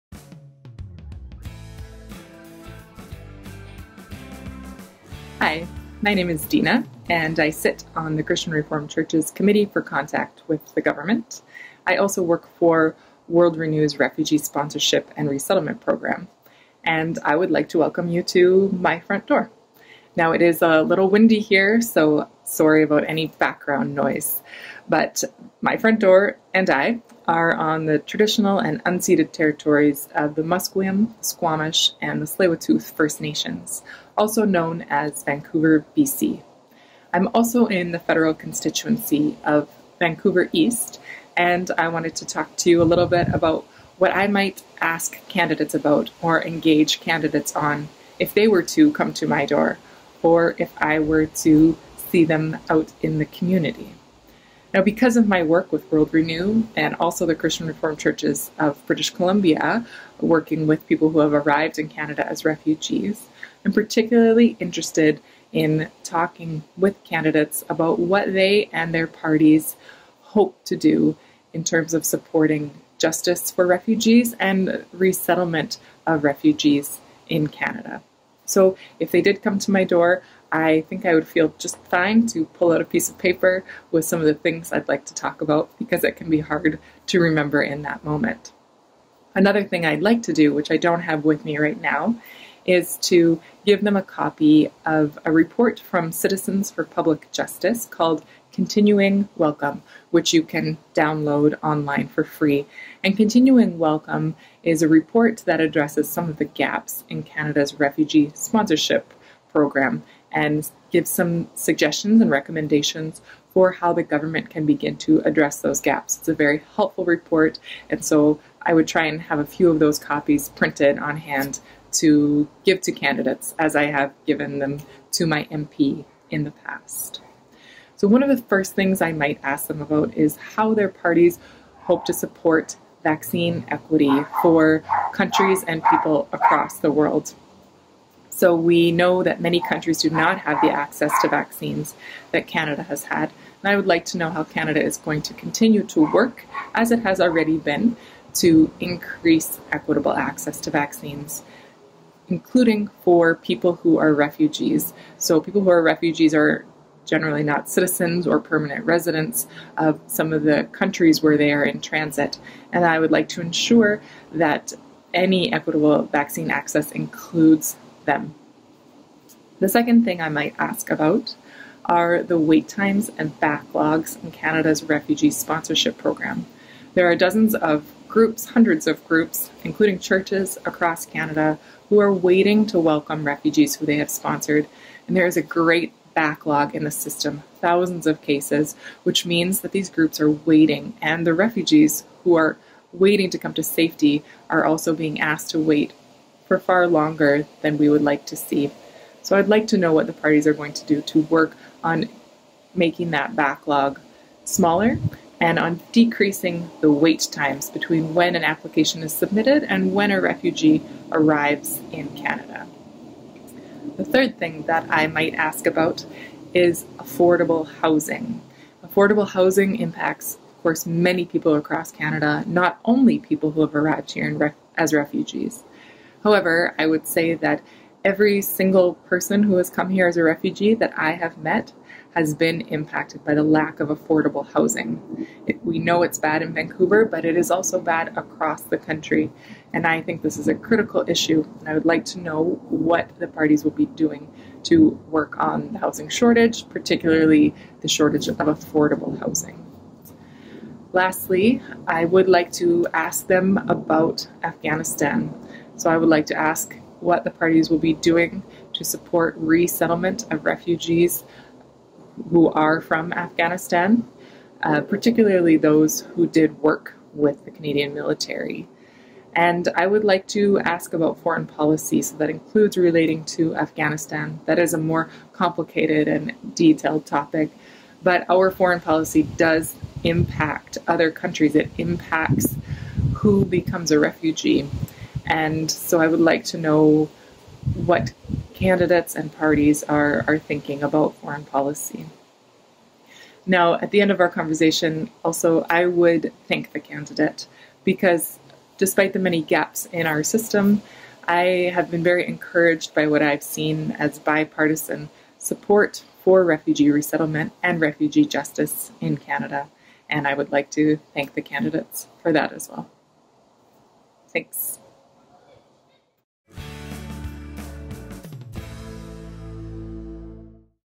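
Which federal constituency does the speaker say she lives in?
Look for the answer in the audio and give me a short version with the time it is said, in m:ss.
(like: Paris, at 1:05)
Vancouver East, at 0:39.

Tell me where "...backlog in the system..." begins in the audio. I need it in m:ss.
3:06.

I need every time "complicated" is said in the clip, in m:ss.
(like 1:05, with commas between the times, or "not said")
4:35.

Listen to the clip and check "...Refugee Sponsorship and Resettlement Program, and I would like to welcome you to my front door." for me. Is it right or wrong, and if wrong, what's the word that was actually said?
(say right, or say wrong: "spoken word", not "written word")
right.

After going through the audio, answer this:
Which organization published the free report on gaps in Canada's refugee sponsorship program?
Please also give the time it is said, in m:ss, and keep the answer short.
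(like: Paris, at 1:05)
Citizens for Public Justice, at 1:36.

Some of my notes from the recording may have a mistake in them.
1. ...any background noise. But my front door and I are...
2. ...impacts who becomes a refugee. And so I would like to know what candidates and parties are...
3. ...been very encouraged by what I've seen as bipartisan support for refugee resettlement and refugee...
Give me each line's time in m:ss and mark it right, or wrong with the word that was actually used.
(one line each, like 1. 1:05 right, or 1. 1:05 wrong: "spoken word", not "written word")
1. 0:23 right
2. 4:41 right
3. 5:01 right.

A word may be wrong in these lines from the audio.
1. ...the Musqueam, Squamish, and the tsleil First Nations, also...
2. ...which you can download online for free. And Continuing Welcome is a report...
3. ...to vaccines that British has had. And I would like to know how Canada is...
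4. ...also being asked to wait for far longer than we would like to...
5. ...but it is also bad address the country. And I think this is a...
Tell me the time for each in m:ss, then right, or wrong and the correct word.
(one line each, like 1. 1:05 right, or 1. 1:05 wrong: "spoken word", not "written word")
1. 0:30 right
2. 1:40 right
3. 2:21 wrong: "Canada", not "British"
4. 3:14 right
5. 3:57 wrong: "across", not "address".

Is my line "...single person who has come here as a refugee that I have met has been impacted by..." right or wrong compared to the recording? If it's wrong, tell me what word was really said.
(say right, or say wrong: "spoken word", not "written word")
right.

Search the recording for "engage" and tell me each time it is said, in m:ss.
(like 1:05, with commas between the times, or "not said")
0:46.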